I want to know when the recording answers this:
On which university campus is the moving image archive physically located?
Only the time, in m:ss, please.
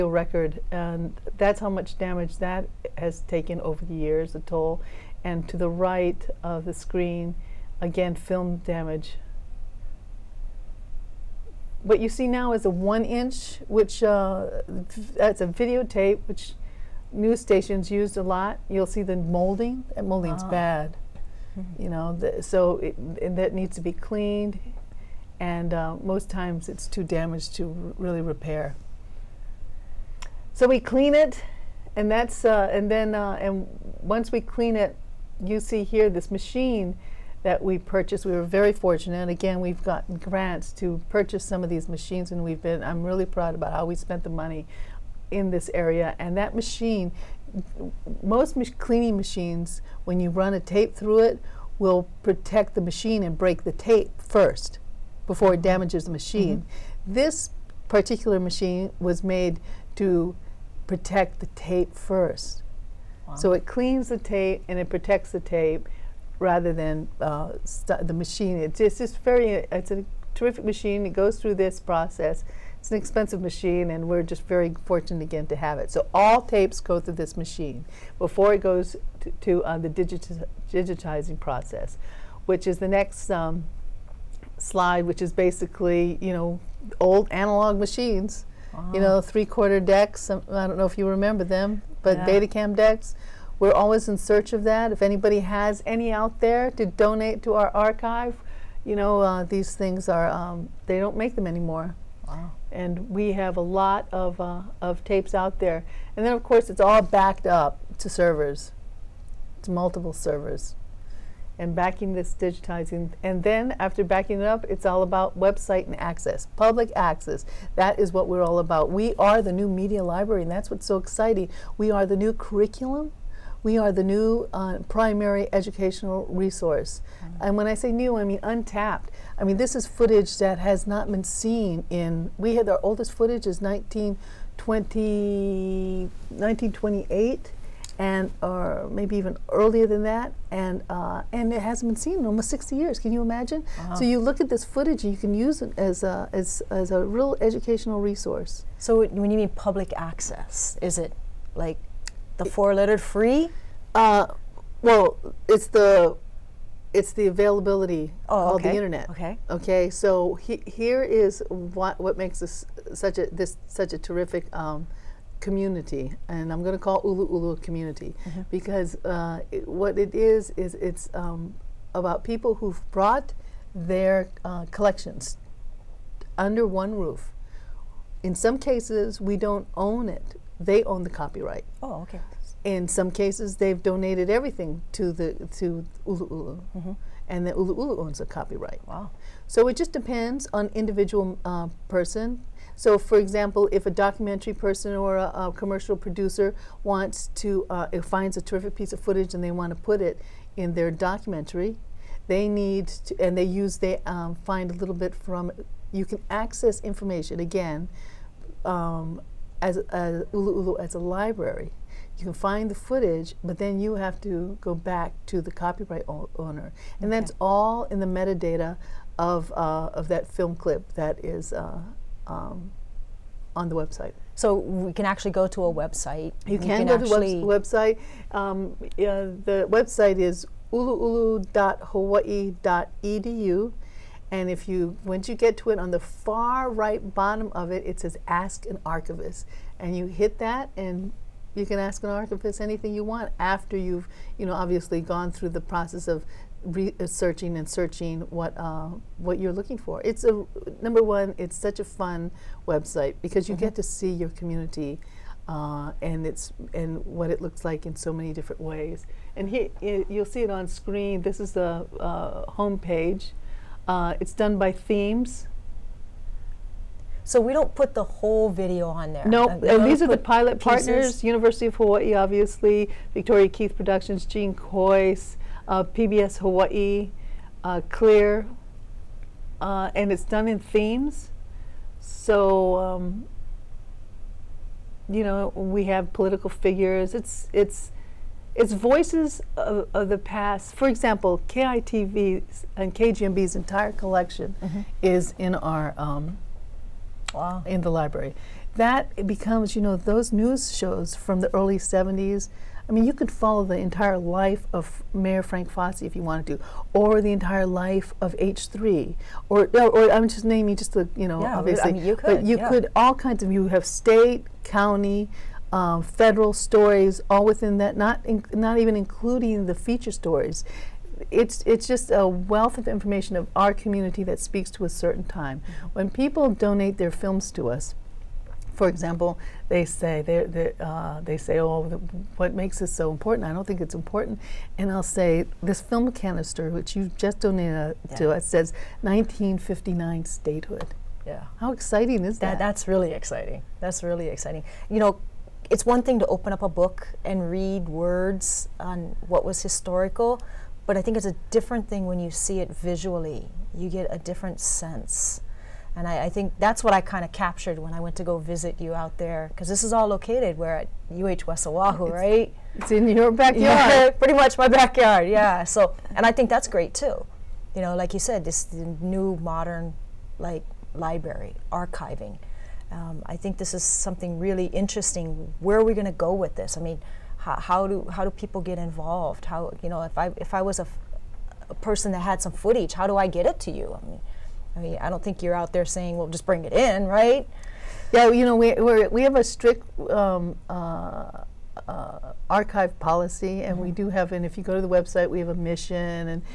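6:01.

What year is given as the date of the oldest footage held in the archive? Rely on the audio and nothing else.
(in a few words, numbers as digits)
1928.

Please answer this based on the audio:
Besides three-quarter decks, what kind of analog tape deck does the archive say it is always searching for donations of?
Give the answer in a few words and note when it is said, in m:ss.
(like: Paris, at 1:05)
Betacam decks, at 1:32.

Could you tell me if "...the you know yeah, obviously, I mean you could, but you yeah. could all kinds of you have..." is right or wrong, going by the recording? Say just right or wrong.
right.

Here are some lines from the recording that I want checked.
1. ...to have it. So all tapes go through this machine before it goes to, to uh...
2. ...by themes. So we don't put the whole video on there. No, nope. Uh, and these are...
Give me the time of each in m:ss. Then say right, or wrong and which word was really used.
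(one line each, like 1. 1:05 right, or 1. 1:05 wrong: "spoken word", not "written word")
1. 1:15 right
2. 4:24 right.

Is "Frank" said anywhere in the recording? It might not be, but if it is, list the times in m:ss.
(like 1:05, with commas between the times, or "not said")
5:05.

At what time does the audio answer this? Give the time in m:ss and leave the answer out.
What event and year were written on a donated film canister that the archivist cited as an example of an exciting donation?
5:39.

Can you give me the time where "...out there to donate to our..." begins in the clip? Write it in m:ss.
1:36.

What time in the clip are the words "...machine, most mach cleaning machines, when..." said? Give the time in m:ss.
0:46.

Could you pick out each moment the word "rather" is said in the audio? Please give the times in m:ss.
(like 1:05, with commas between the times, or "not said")
1:06.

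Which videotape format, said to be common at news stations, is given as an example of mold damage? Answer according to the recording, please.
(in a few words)
one inch.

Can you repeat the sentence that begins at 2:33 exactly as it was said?
Uh, well, it's the it's the availability oh, okay.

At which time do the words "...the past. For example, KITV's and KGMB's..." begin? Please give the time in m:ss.
4:50.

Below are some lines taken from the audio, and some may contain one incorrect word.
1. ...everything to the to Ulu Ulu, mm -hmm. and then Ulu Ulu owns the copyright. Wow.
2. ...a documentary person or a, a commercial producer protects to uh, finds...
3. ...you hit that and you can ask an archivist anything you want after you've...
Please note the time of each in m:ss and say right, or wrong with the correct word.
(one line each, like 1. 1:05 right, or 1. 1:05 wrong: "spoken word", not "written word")
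1. 3:04 right
2. 3:13 wrong: "wants", not "protects"
3. 3:59 right.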